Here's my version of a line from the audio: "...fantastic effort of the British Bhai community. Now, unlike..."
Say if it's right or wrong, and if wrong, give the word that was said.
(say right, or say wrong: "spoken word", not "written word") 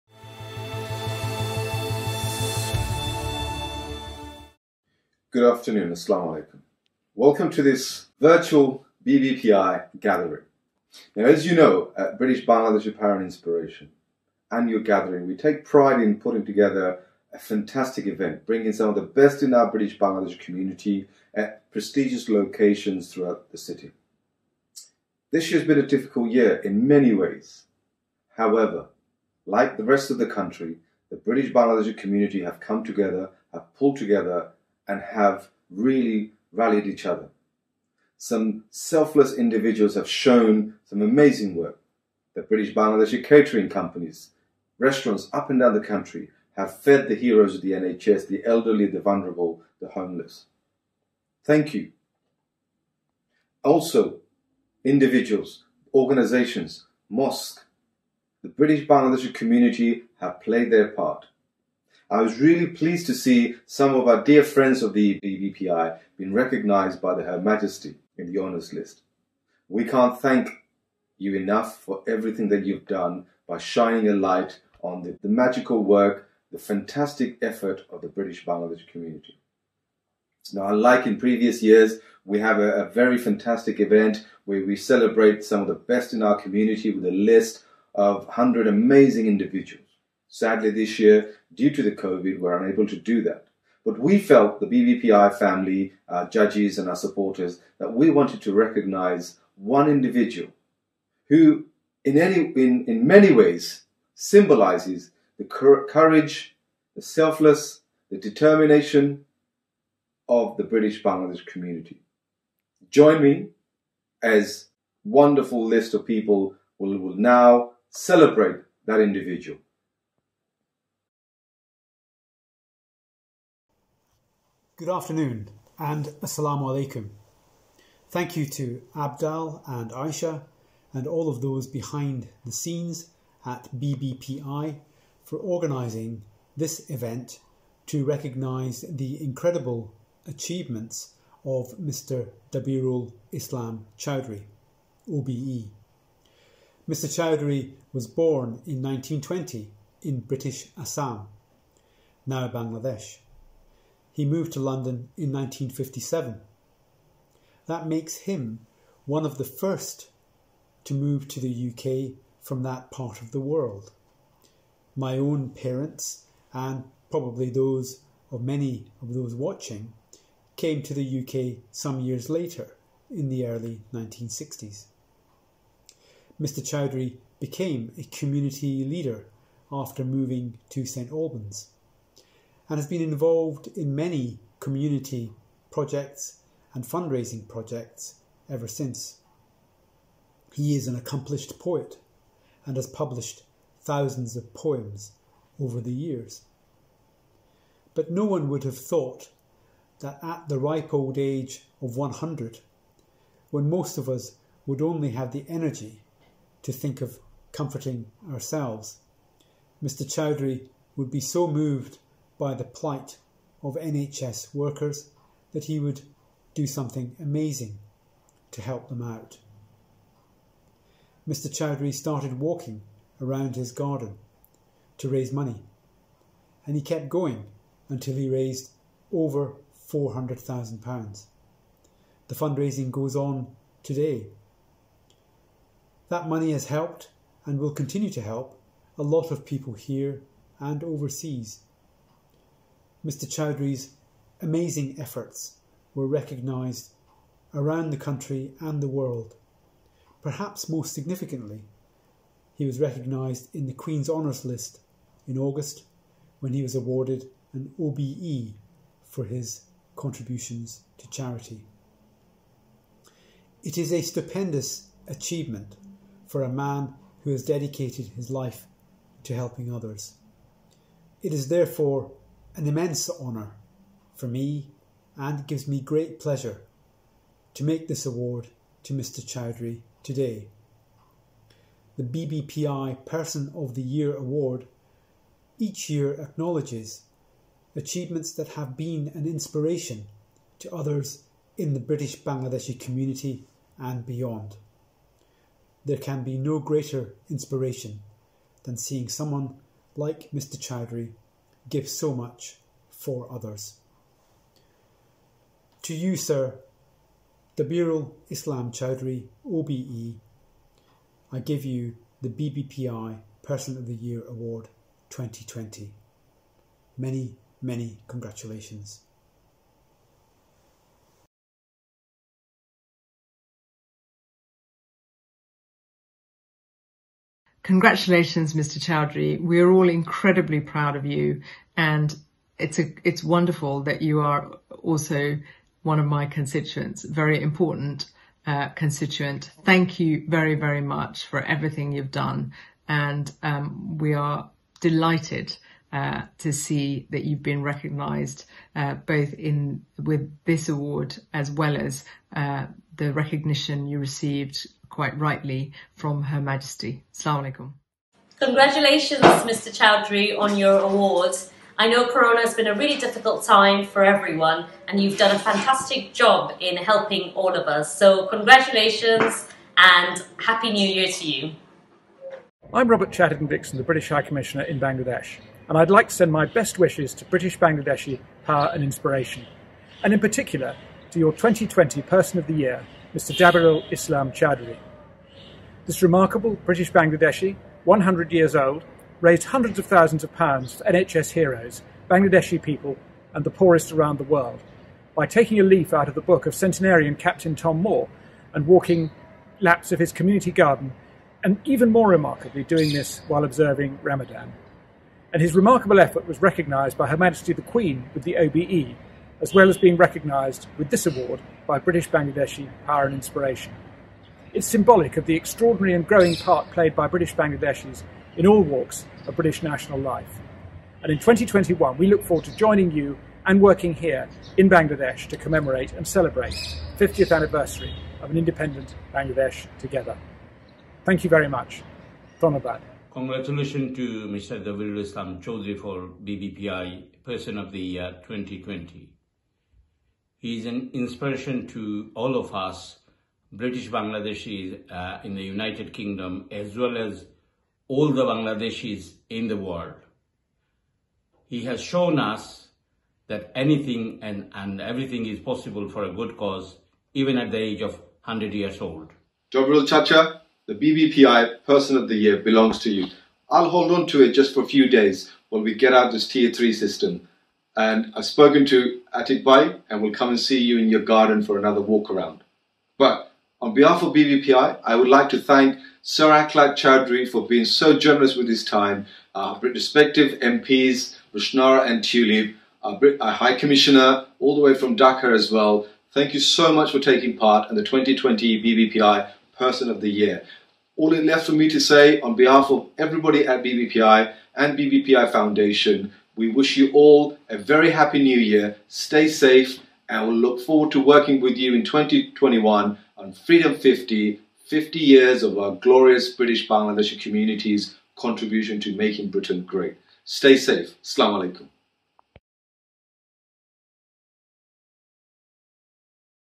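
wrong: "Bangladesh", not "Bhai".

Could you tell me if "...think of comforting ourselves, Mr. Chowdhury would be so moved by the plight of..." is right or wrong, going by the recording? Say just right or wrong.
right.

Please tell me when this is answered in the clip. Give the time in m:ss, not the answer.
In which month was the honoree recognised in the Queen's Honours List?
4:15.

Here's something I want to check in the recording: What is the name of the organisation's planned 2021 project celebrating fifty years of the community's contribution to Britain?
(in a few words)
Freedom 50.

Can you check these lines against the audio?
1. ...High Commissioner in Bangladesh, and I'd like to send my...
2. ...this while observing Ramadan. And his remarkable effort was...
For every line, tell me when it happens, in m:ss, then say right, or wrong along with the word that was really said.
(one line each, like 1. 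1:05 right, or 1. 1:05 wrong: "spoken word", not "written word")
1. 6:14 right
2. 6:42 right.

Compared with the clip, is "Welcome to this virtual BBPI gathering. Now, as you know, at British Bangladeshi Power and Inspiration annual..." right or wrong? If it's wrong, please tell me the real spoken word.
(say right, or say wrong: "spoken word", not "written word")
right.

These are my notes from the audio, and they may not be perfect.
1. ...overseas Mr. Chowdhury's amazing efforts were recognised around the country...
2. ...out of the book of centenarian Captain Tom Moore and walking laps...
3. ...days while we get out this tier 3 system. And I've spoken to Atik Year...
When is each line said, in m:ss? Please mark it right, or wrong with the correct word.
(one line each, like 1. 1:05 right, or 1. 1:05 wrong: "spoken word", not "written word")
1. 4:00 right
2. 6:35 right
3. 7:44 wrong: "Bhai", not "Year".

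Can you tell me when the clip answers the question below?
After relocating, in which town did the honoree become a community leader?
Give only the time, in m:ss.
3:00.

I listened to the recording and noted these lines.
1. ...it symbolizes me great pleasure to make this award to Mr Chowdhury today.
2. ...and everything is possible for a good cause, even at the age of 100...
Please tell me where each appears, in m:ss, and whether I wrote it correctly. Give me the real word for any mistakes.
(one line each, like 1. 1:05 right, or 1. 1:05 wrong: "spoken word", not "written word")
1. 4:35 wrong: "gives", not "symbolizes"
2. 7:34 right.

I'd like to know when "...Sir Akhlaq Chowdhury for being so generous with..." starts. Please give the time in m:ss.
7:56.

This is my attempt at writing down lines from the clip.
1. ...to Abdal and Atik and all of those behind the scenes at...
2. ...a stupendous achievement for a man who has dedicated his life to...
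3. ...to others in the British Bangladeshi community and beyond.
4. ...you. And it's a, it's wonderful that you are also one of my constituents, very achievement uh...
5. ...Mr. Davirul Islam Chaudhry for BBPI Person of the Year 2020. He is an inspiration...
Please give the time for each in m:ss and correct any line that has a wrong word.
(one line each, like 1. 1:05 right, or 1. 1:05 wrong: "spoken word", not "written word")
1. 2:08 wrong: "Aisha", not "Atik"
2. 4:23 right
3. 4:50 right
4. 5:31 wrong: "important", not "achievement"
5. 7:14 right.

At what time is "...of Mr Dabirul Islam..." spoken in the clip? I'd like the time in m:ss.
2:21.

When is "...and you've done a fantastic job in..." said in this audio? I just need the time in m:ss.
6:04.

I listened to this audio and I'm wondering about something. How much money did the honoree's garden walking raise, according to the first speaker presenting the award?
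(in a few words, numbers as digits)
Over £400,000.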